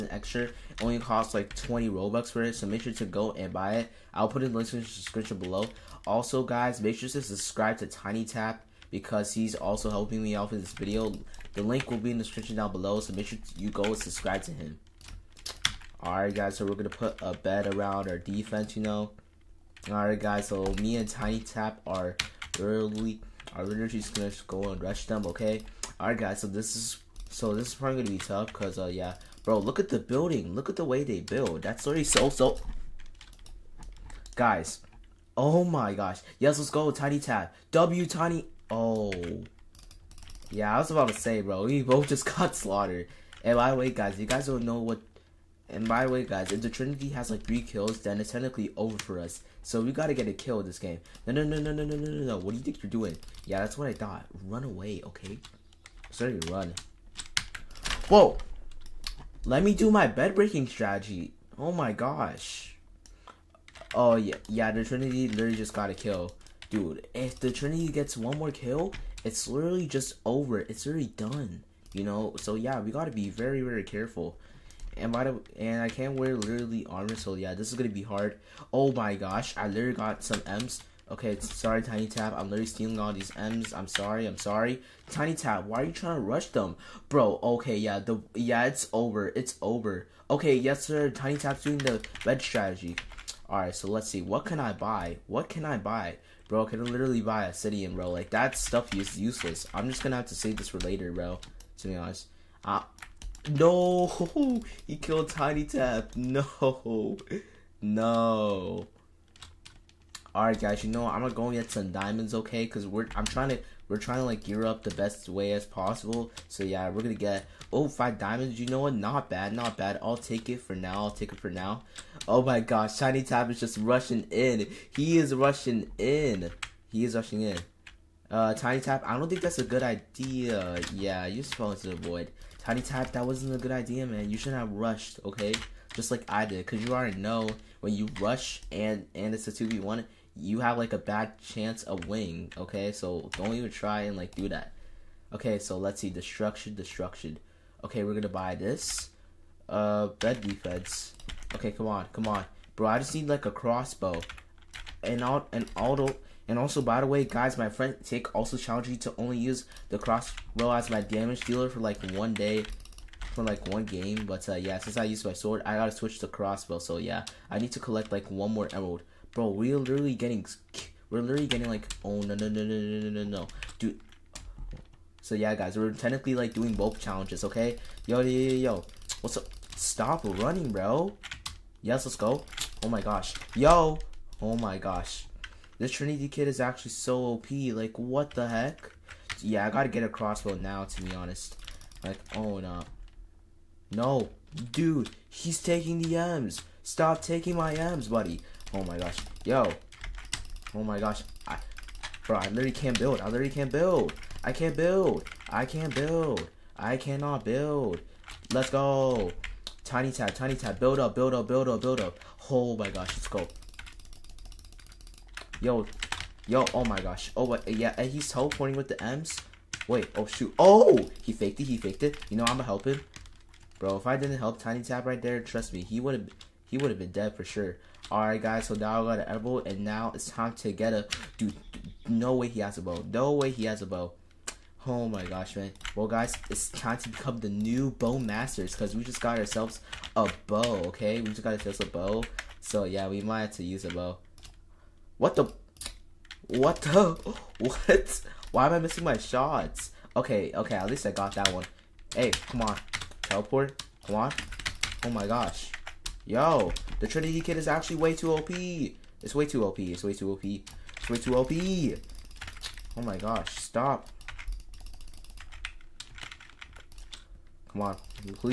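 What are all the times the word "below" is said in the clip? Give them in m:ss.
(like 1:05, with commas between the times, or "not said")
0:05, 0:12.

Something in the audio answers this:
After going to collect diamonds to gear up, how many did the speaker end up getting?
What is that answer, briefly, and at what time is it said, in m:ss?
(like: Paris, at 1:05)
5, at 1:57.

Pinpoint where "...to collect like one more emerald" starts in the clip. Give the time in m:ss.
2:47.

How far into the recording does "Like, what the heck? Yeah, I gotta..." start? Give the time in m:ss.
3:07.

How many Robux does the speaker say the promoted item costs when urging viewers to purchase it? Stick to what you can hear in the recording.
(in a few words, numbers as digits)
20 Robux.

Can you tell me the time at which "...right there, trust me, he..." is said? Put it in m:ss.
3:45.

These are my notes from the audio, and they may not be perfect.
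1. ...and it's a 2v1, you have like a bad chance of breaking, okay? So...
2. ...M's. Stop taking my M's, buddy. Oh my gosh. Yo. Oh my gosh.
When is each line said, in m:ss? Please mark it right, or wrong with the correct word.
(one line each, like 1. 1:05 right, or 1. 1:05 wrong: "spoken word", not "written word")
1. 2:19 wrong: "winning", not "breaking"
2. 3:16 right.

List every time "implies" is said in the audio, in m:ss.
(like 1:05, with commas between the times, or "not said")
not said.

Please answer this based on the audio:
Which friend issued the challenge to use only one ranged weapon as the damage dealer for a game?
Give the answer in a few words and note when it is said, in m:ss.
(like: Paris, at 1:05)
Tick, at 2:38.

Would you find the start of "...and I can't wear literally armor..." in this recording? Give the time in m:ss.
1:15.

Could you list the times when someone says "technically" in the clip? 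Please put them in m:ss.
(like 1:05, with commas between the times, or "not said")
0:48, 2:55.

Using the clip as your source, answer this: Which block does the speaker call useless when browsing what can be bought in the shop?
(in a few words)
obsidian.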